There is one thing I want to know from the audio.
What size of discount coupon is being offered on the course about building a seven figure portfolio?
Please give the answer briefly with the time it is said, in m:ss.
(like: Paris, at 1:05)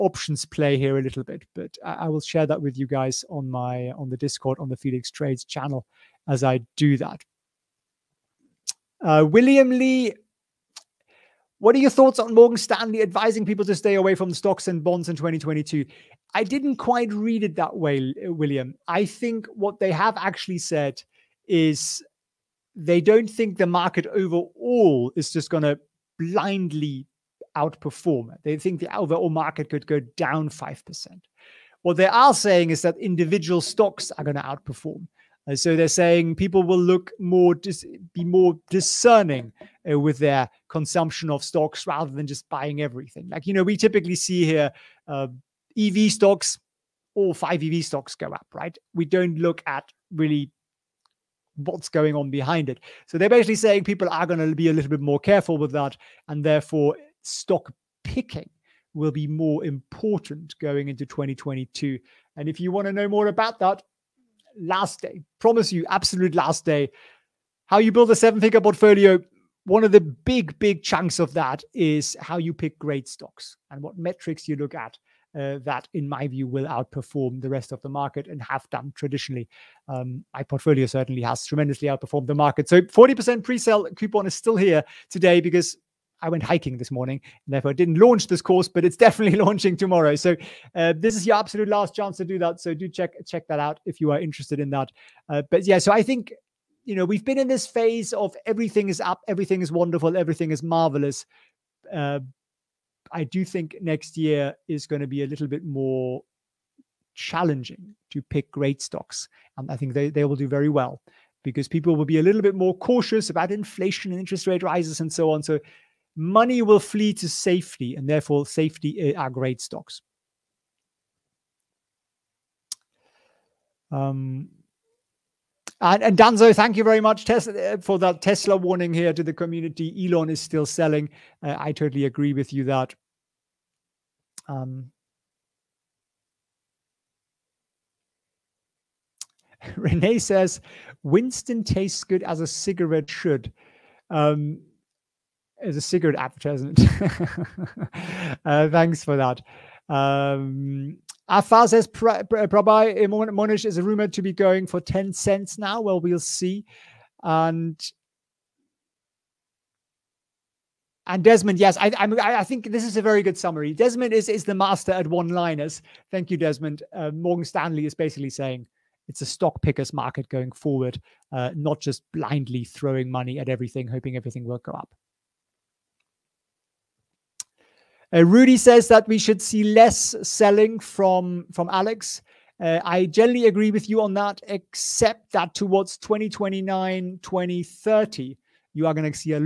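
40%, at 1:22.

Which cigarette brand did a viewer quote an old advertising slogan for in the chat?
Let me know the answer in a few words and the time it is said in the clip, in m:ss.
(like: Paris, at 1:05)
Winston, at 2:21.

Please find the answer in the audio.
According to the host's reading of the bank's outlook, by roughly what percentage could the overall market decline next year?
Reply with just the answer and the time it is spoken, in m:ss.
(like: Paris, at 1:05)
5%, at 0:30.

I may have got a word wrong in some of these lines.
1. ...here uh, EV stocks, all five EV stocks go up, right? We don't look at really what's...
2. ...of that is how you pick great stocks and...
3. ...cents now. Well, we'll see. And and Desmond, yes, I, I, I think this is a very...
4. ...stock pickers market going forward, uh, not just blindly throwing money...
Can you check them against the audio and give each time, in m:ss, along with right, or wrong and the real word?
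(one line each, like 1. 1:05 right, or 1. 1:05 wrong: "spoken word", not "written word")
1. 0:44 right
2. 1:11 right
3. 2:35 right
4. 2:49 right.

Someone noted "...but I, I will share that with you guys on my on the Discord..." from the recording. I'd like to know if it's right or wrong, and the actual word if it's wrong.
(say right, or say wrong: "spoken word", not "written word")
right.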